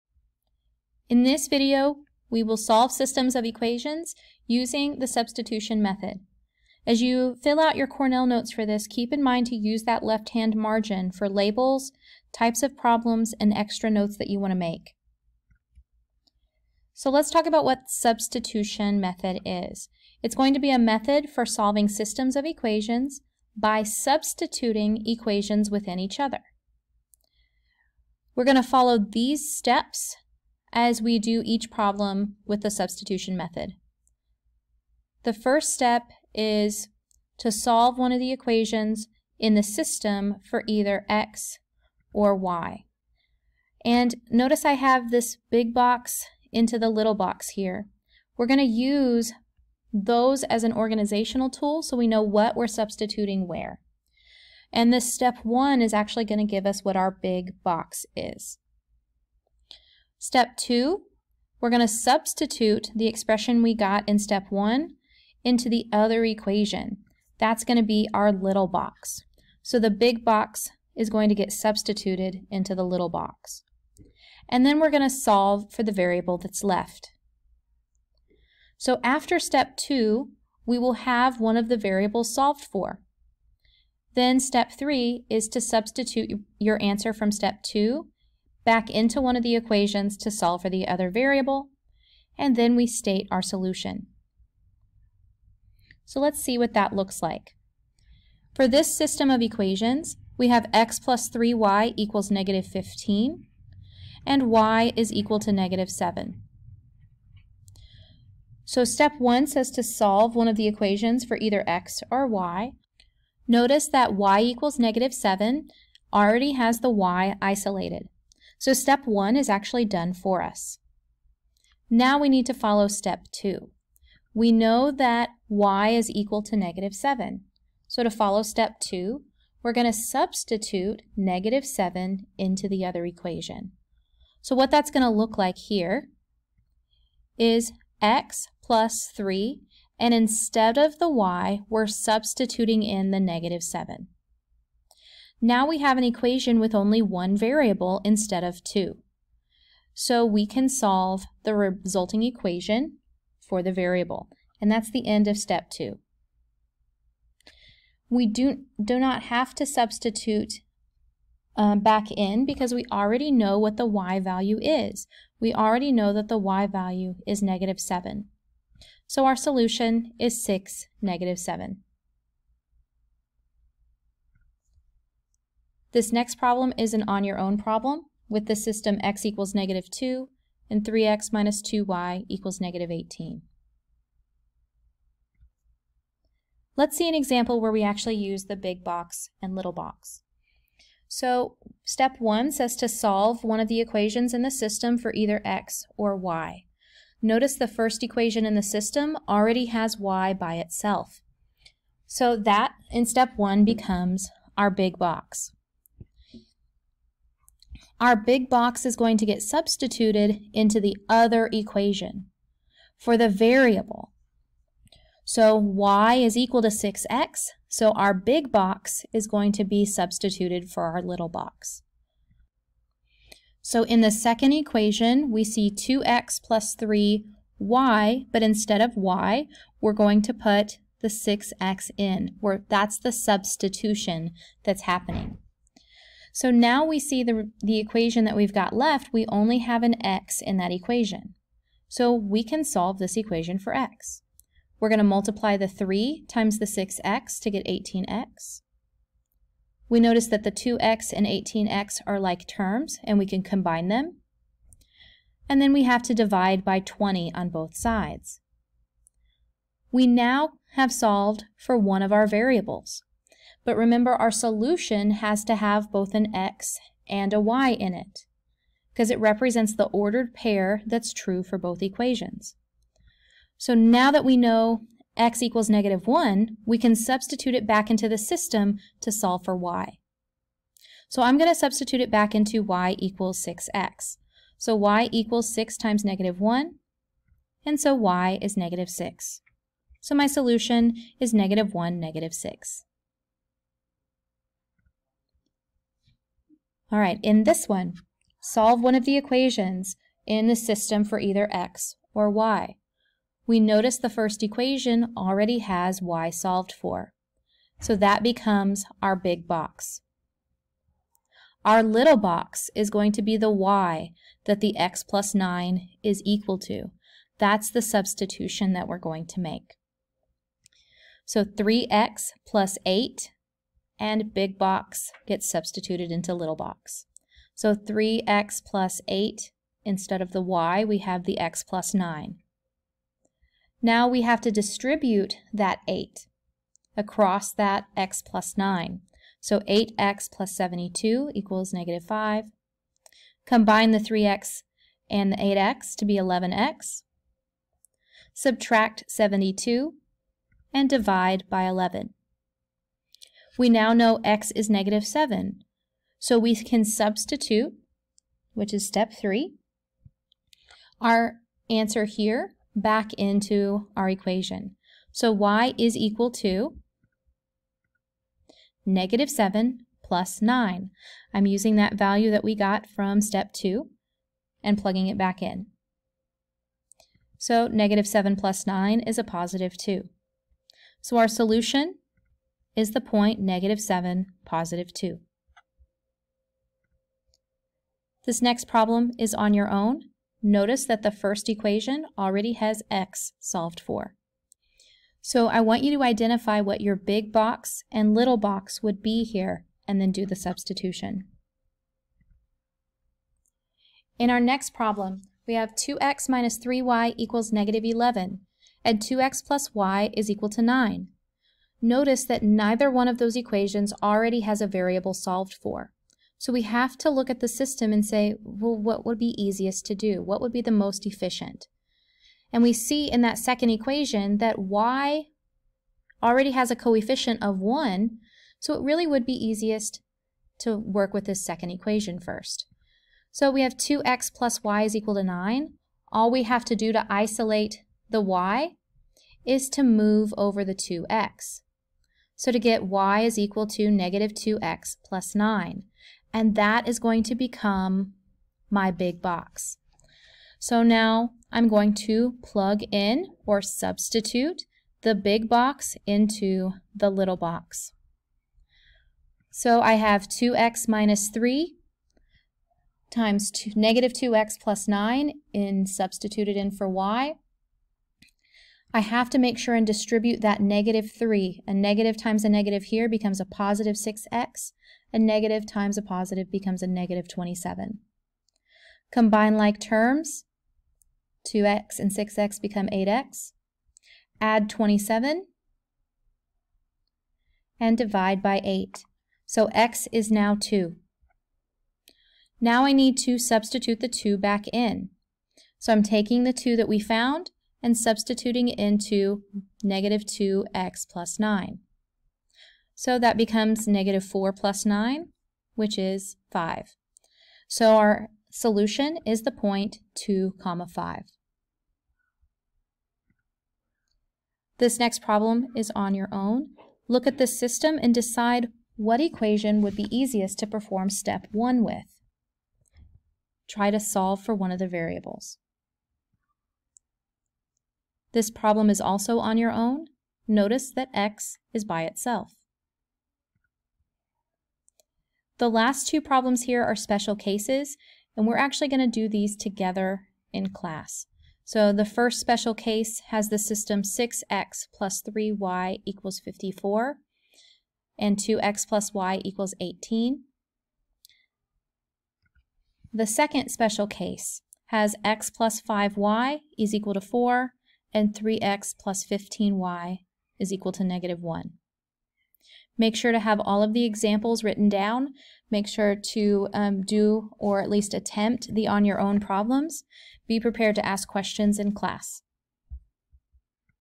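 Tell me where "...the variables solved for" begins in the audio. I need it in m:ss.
1:21.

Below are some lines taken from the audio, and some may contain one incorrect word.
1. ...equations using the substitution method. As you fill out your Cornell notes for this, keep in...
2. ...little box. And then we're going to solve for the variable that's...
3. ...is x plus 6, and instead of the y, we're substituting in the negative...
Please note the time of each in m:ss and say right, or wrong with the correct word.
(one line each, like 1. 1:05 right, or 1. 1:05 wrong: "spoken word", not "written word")
1. 0:03 right
2. 1:12 right
3. 2:17 wrong: "3", not "6".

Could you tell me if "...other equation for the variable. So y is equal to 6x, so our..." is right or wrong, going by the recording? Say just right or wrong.
right.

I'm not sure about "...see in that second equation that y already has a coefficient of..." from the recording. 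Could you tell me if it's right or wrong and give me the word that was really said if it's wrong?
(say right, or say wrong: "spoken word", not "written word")
right.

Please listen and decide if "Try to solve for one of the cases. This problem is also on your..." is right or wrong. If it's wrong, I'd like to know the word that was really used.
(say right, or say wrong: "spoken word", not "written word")
wrong: "variables", not "cases".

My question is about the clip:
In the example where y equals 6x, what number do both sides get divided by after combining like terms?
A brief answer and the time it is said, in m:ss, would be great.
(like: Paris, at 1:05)
20, at 4:16.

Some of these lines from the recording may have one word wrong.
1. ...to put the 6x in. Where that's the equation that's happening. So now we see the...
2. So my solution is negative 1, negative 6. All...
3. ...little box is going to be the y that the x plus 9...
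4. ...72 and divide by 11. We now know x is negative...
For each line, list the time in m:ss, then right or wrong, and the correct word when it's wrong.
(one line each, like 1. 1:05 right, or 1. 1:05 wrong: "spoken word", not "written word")
1. 3:50 wrong: "substitution", not "equation"
2. 4:49 right
3. 5:11 right
4. 5:49 right.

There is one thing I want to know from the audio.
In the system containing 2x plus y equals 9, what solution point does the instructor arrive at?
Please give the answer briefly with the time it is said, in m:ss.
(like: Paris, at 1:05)
(2, 5), at 8:30.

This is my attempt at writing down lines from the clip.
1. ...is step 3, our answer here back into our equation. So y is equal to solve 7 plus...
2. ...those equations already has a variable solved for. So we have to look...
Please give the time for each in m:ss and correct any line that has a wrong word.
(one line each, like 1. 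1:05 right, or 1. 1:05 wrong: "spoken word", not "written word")
1. 5:58 wrong: "negative", not "solve"
2. 6:53 right.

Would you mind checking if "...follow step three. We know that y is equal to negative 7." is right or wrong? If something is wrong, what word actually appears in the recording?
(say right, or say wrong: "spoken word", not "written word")
wrong: "two", not "three".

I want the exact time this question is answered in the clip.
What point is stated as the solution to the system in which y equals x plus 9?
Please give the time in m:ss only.
6:23.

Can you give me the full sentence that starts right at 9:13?
The second special case has x plus 5y is equal to 4, and 3x plus 15y is equal to negative 1.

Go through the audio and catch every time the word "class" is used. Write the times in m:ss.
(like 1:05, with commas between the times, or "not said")
9:00, 9:31.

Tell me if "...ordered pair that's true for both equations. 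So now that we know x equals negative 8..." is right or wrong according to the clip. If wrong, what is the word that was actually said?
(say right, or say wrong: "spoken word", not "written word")
wrong: "1", not "8".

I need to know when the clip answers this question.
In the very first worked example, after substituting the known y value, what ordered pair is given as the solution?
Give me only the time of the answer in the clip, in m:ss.
2:50.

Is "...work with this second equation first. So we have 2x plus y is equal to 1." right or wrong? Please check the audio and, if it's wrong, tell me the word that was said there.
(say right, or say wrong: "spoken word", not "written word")
wrong: "9", not "1".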